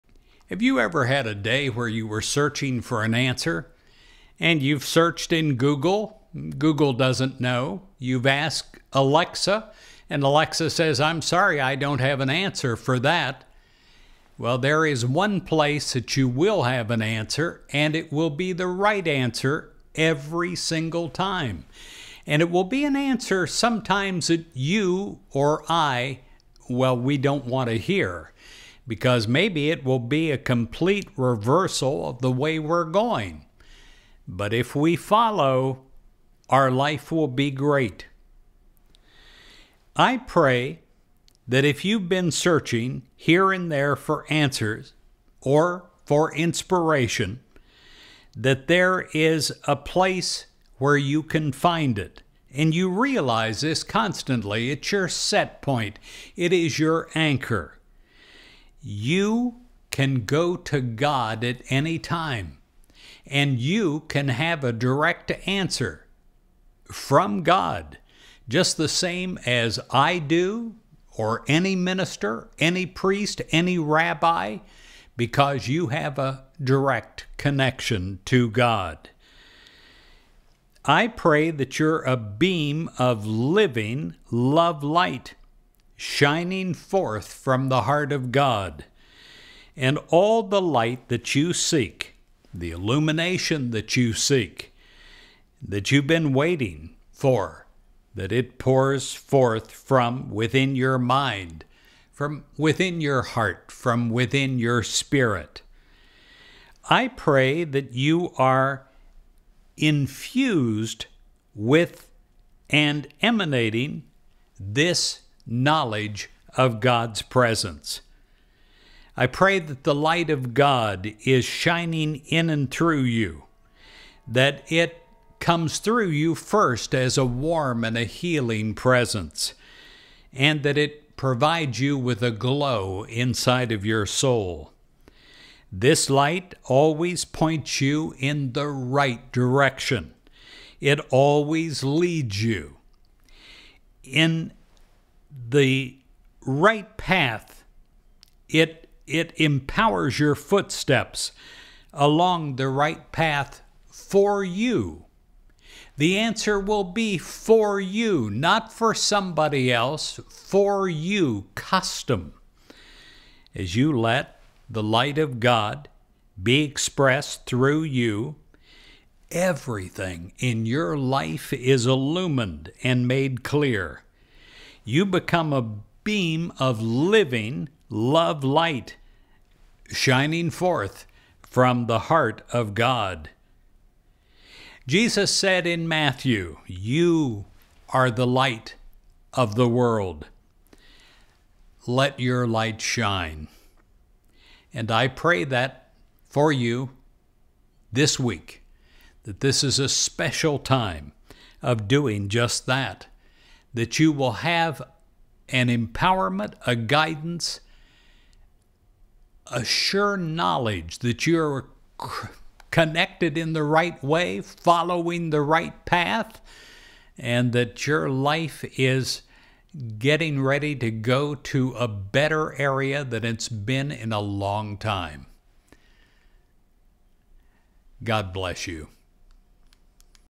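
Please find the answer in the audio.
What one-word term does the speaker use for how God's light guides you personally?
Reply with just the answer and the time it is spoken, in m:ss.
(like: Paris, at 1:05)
custom, at 2:41.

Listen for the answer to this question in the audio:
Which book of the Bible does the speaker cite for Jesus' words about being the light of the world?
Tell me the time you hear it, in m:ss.
3:05.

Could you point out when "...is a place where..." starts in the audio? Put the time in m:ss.
0:49.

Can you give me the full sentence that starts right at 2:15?
This light always points you in the right direction.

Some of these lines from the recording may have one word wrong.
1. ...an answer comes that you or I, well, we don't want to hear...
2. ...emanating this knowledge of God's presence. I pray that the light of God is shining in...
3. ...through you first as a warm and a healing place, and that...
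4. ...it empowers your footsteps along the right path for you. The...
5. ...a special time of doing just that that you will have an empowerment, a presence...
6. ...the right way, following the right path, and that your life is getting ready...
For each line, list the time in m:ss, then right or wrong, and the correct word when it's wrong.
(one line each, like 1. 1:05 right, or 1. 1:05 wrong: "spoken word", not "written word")
1. 0:22 wrong: "sometimes", not "comes"
2. 1:53 right
3. 2:05 wrong: "presence", not "place"
4. 2:29 right
5. 3:19 wrong: "guidance", not "presence"
6. 3:33 right.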